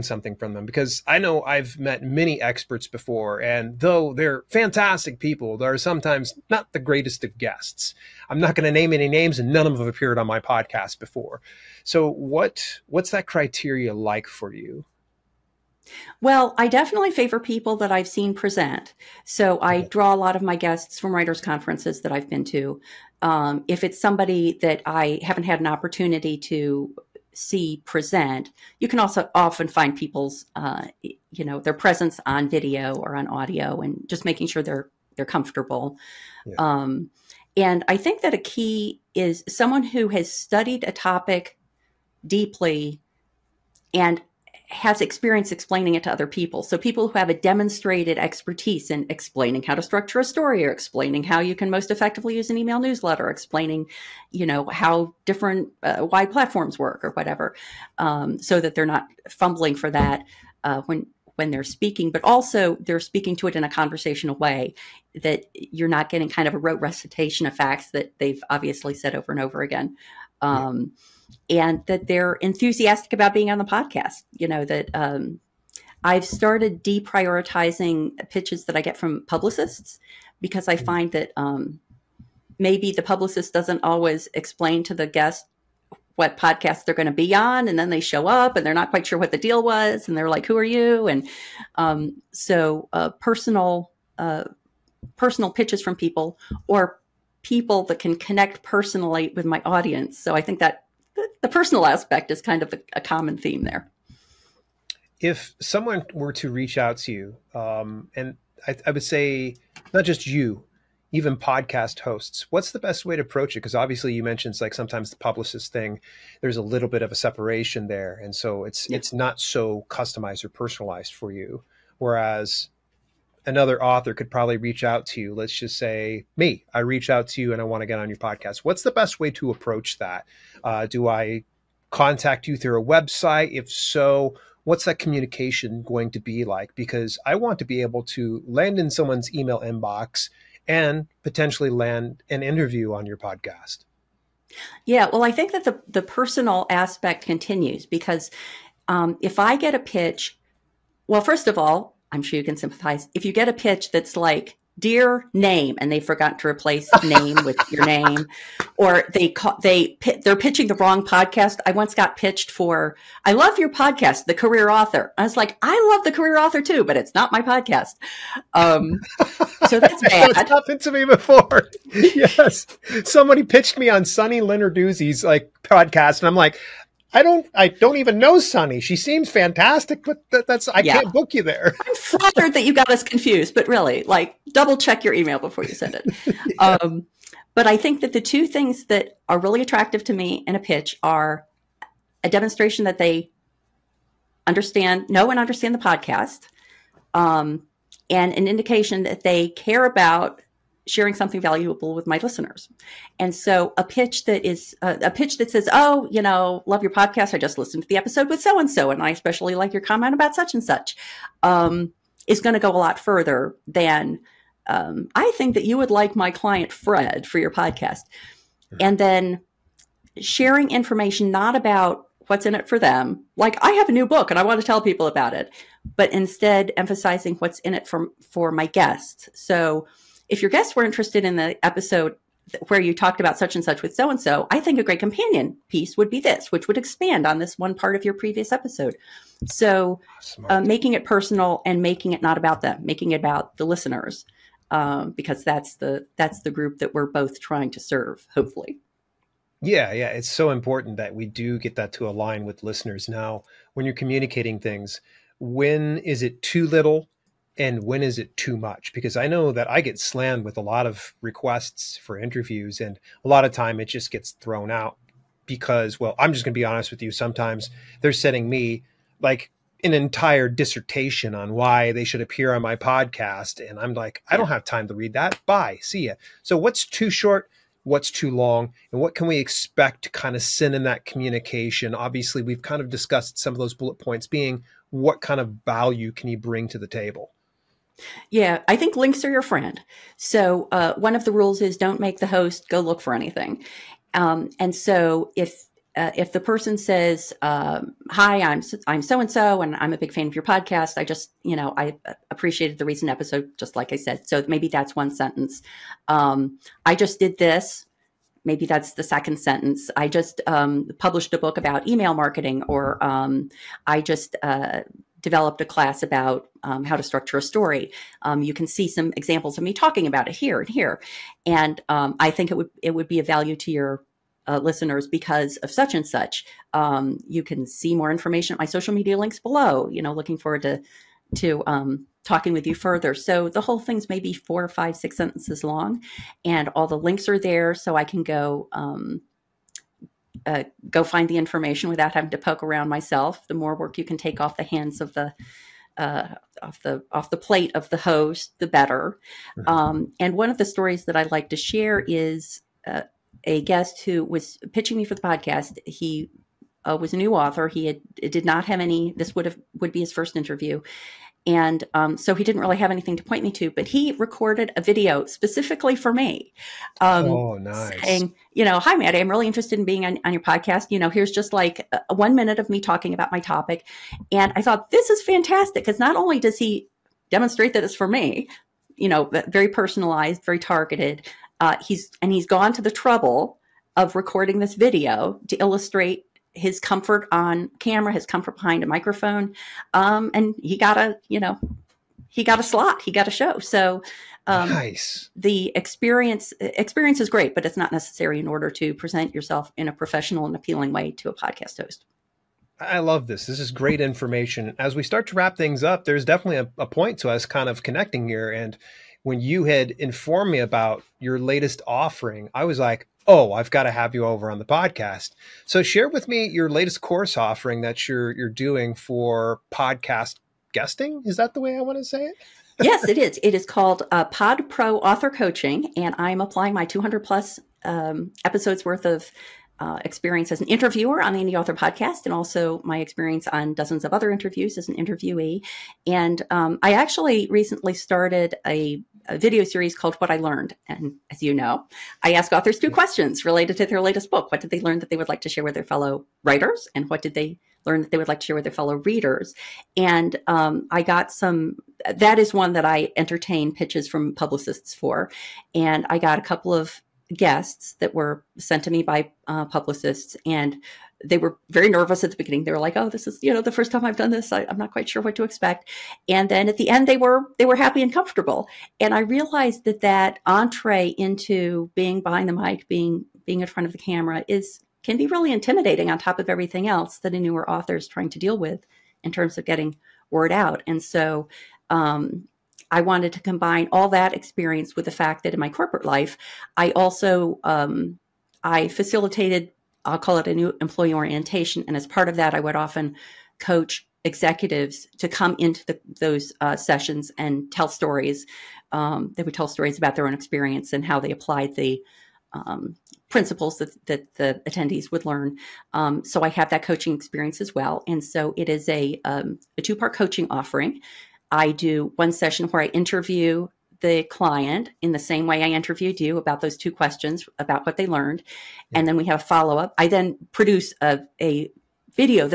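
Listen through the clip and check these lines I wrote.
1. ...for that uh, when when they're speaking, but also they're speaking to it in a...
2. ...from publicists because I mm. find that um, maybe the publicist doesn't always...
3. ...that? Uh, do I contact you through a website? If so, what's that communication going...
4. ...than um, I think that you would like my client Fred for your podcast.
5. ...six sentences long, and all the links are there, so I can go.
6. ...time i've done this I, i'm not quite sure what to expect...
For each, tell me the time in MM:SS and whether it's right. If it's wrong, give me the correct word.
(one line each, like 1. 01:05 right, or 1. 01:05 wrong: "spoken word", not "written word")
1. 00:59 right
2. 01:18 right
3. 02:09 right
4. 03:33 right
5. 05:34 right
6. 07:43 right.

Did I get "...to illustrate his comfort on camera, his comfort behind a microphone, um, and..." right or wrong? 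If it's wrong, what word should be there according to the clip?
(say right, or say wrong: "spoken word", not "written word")
right.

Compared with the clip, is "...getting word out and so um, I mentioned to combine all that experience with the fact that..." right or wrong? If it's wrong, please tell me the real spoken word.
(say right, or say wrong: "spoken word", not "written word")
wrong: "wanted", not "mentioned".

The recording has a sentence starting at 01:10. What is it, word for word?
Um, yeah and that they're enthusiastic about being on the podcast.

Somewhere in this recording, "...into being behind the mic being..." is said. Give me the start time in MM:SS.
07:51.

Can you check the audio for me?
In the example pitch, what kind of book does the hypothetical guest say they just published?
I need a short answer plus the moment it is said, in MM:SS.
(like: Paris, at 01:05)
Email marketing, at 05:11.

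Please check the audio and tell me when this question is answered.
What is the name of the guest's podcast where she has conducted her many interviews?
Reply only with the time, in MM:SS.
07:11.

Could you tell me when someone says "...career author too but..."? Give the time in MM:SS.
02:46.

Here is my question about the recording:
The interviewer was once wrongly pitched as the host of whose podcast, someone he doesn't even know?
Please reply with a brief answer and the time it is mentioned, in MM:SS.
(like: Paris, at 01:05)
Sunny Lenarduzzi, at 02:54.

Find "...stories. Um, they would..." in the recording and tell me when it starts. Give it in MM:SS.
08:17.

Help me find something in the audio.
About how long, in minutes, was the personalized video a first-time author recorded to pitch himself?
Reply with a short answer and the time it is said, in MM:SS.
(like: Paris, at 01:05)
1, at 06:12.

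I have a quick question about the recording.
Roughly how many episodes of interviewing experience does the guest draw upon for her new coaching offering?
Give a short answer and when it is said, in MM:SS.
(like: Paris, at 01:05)
200 plus, at 07:06.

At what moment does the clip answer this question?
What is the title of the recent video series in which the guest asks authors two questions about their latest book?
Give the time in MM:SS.
07:20.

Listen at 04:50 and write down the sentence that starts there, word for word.
So uh, one of the rules is don't make the host go look for anything.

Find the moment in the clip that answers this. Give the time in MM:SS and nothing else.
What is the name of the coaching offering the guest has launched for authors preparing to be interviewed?
07:04.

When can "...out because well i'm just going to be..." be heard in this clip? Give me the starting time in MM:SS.
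04:24.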